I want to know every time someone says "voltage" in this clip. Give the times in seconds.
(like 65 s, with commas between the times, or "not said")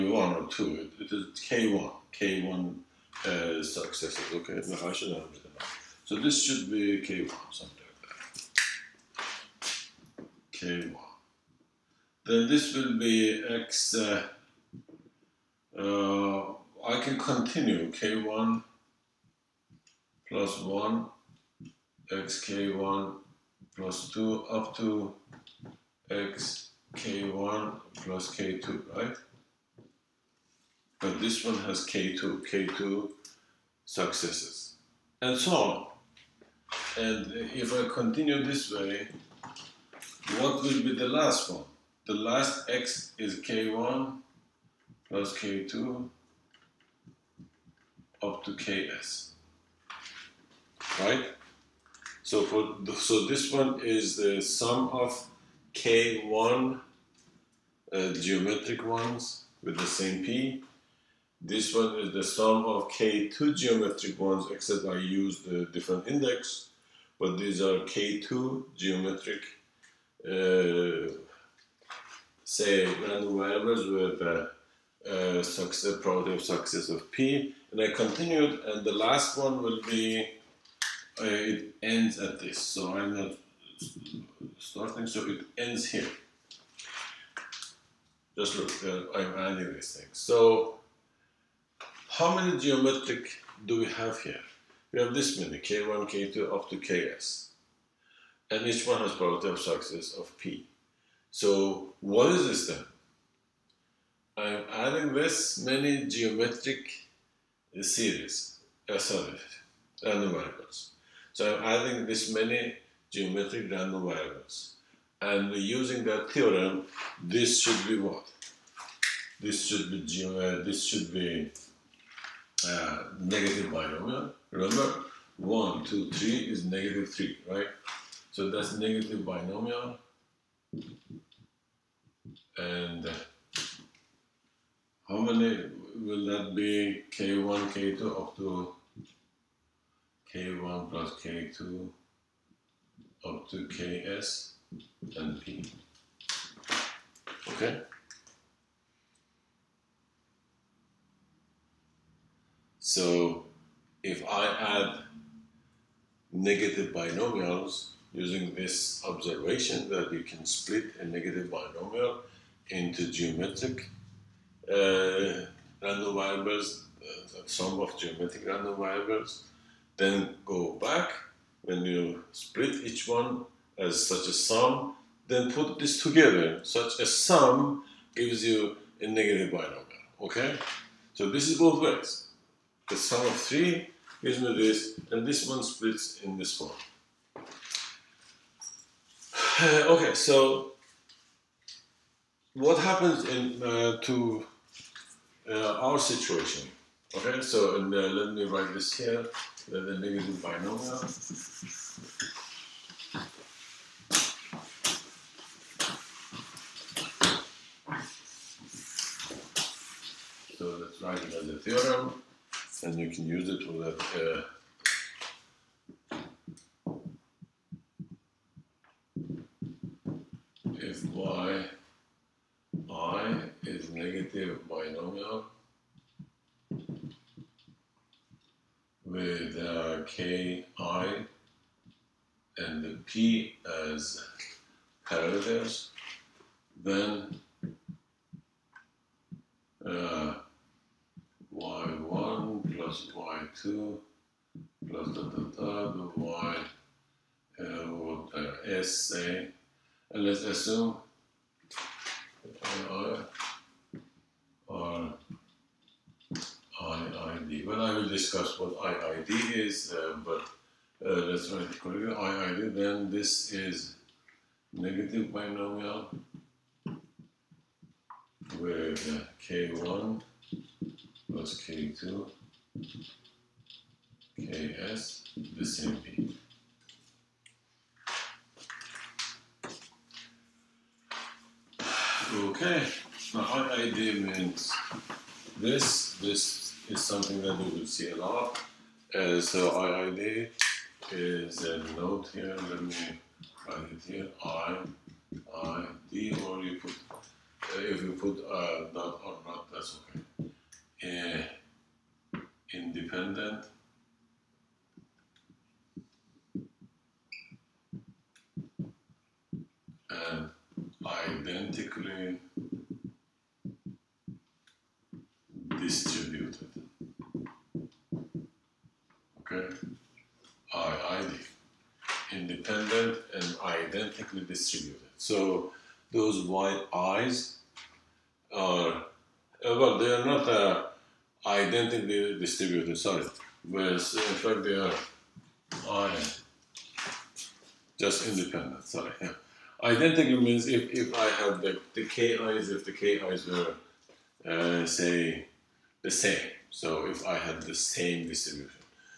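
not said.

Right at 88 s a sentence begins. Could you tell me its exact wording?
Just look, uh, I'm adding these things.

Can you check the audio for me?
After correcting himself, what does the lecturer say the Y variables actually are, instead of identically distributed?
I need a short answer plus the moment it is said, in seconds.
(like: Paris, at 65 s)
just independent, at 337 s.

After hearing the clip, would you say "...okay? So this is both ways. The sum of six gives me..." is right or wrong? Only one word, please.
wrong.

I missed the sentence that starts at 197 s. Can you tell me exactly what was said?
Okay, so and, uh, let me write this here, the, the negative binomial.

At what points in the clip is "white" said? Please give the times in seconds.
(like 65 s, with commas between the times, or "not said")
326 s.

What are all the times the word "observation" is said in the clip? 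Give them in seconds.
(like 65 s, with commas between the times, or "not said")
159 s.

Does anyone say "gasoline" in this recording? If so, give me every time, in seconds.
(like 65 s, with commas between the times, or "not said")
not said.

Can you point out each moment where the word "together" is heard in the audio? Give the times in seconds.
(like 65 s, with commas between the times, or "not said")
176 s.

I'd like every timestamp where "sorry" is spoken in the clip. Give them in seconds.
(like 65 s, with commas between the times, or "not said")
108 s, 332 s, 338 s.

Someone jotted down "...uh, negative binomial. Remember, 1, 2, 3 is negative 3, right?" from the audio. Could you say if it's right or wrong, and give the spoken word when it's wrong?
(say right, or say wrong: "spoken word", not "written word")
right.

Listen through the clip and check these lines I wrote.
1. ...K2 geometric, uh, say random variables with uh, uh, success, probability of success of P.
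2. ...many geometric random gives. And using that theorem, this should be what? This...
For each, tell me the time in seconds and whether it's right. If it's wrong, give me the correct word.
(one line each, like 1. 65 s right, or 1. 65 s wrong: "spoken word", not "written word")
1. 67 s right
2. 112 s wrong: "variables", not "gives".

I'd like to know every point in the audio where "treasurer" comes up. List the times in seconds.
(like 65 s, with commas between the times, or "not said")
not said.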